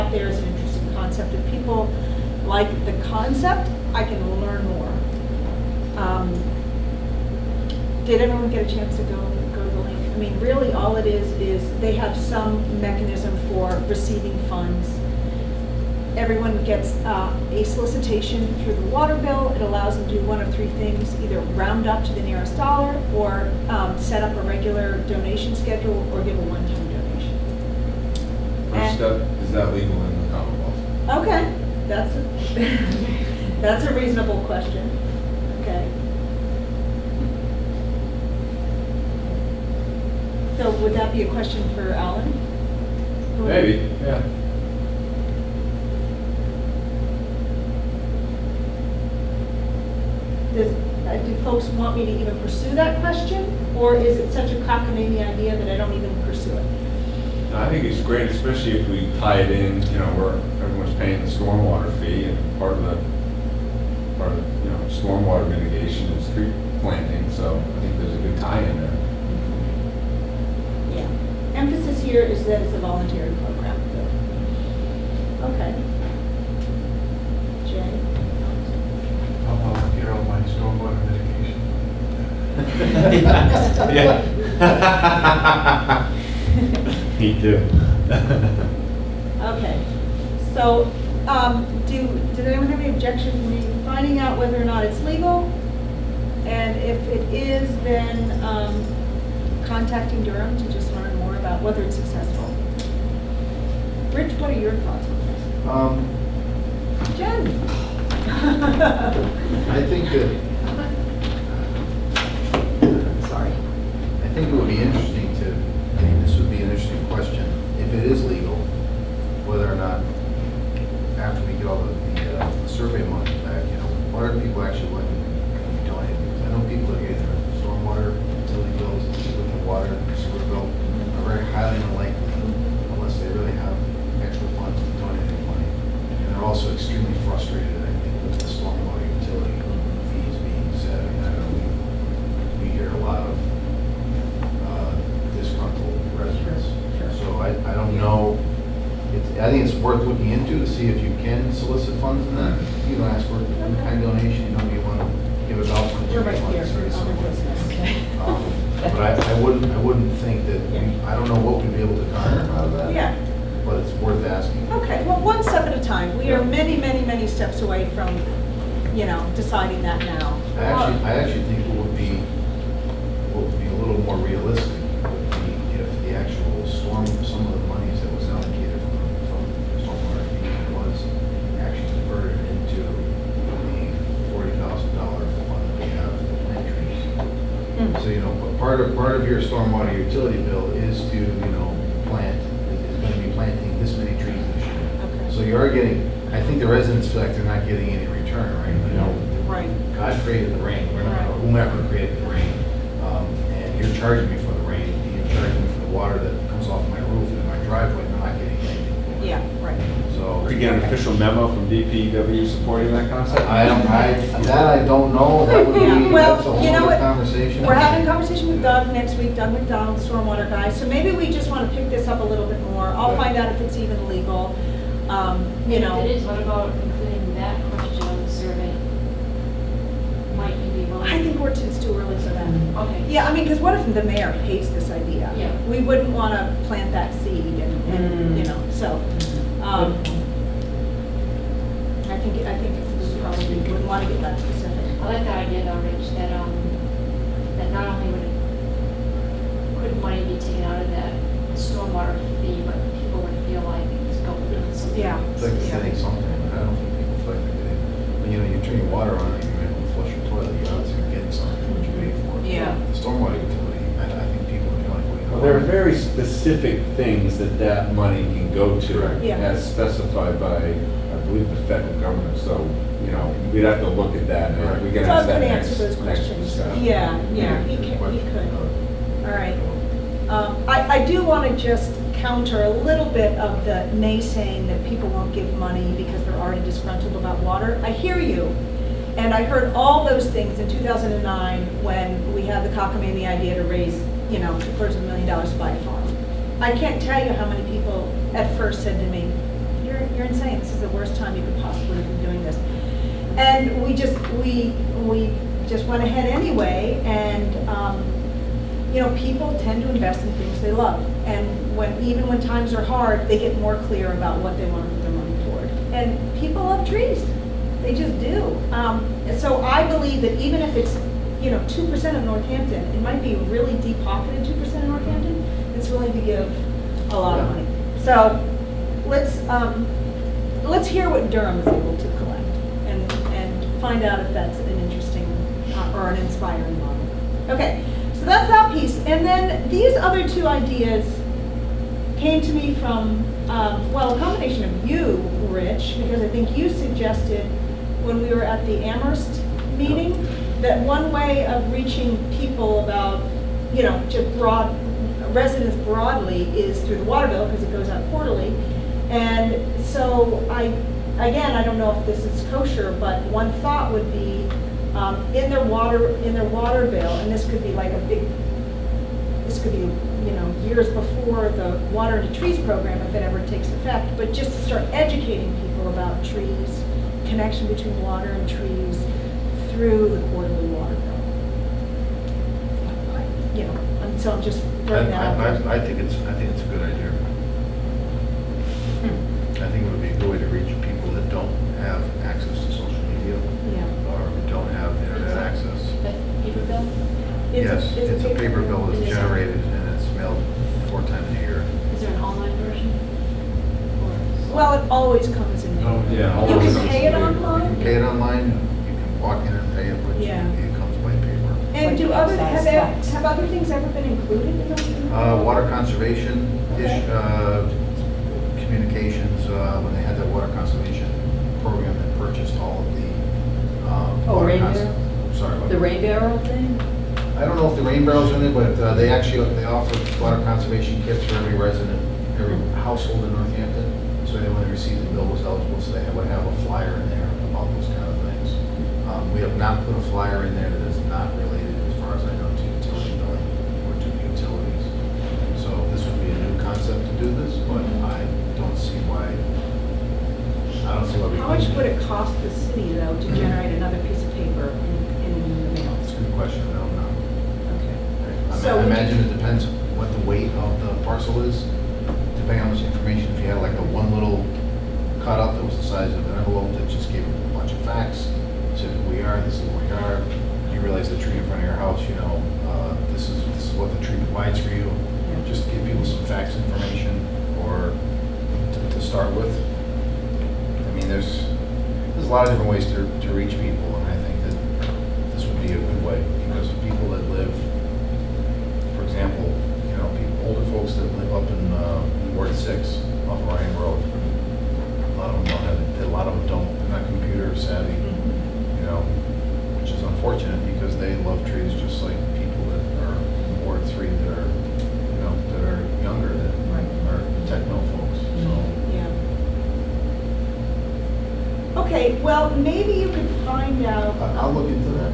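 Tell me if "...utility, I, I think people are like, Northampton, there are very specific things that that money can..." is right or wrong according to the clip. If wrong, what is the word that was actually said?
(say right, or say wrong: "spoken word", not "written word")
wrong: "Well", not "Northampton".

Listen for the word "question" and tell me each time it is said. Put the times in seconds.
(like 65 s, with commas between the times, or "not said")
34 s, 41 s, 53 s, 117 s, 227 s, 275 s, 456 s.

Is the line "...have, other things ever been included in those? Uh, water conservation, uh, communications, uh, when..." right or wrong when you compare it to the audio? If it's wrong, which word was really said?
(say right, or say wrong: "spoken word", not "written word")
right.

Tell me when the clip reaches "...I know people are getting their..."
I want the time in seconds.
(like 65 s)
126 s.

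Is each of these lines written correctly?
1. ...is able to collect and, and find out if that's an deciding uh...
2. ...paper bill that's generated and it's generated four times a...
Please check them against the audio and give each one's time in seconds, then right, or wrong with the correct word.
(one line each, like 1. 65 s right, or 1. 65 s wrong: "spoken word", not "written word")
1. 331 s wrong: "interesting", not "deciding"
2. 398 s wrong: "mailed", not "generated".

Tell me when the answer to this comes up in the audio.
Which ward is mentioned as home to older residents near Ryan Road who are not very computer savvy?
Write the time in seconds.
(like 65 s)
492 s.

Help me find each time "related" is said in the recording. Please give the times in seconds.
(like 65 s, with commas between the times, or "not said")
441 s.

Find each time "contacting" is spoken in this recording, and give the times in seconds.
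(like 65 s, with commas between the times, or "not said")
99 s.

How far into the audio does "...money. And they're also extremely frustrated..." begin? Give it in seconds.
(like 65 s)
135 s.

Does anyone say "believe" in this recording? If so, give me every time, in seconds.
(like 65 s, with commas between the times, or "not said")
271 s, 319 s.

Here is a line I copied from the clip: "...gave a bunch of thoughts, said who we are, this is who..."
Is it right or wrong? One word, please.
wrong.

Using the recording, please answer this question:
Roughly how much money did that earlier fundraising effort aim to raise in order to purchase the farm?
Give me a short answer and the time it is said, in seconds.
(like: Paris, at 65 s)
two-thirds of a million dollars, at 294 s.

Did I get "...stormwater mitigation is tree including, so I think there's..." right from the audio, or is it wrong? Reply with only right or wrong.
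wrong.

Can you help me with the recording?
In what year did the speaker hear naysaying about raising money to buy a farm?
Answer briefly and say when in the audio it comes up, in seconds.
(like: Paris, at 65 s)
2009, at 290 s.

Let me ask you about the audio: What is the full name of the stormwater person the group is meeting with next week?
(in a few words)
Doug McDonald.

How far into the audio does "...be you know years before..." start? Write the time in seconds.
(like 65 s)
369 s.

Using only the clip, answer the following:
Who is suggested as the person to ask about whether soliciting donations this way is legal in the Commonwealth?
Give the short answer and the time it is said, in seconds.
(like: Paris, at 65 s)
Alan, at 41 s.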